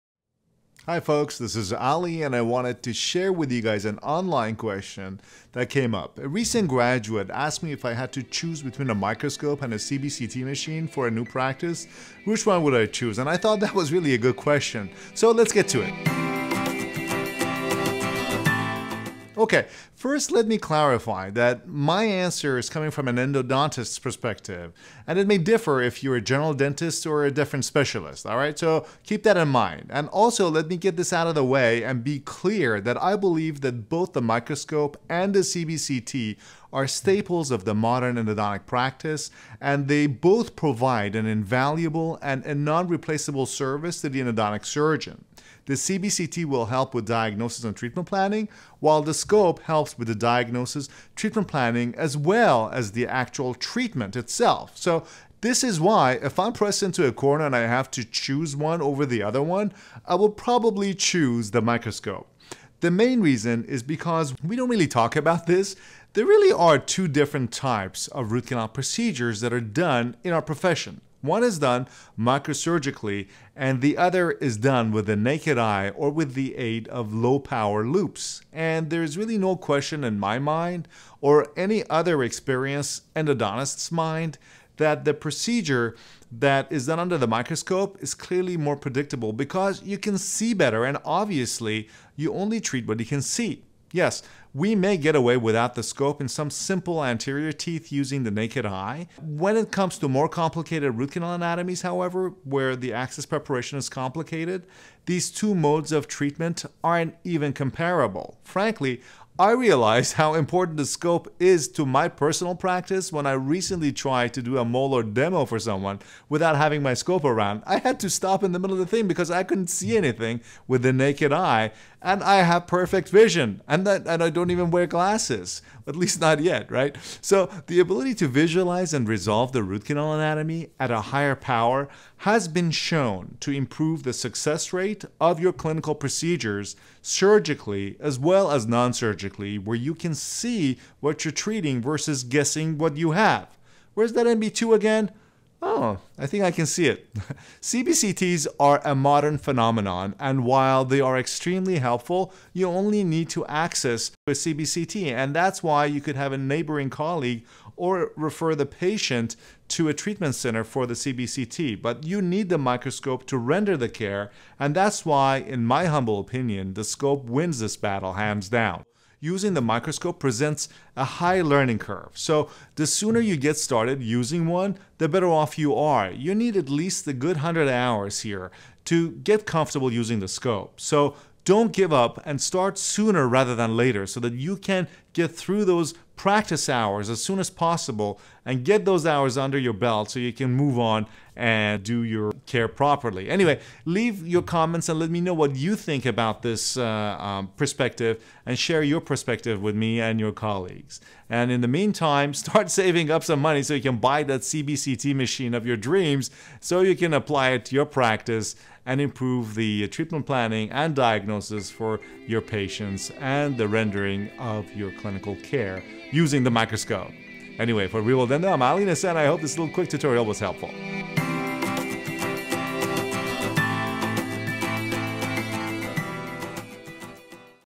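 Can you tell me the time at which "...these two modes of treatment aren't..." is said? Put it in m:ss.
1:45.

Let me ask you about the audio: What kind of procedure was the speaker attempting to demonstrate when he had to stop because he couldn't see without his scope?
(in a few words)
A molar demo.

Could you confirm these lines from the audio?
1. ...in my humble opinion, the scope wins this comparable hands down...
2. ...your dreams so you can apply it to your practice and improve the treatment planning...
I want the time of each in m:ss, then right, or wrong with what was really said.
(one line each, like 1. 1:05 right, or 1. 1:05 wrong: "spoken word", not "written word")
1. 2:45 wrong: "battle", not "comparable"
2. 3:25 right.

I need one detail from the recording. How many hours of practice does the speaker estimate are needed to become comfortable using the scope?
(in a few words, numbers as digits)
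100 hours.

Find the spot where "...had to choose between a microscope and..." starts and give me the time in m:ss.
0:07.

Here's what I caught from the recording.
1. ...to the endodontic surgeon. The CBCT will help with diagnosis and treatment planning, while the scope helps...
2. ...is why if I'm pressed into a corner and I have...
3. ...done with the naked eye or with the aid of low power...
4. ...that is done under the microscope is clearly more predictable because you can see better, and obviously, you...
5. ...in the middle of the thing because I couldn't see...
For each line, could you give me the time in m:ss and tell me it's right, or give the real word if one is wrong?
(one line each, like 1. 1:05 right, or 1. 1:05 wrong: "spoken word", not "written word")
1. 0:44 right
2. 0:55 right
3. 1:14 right
4. 1:26 right
5. 1:58 right.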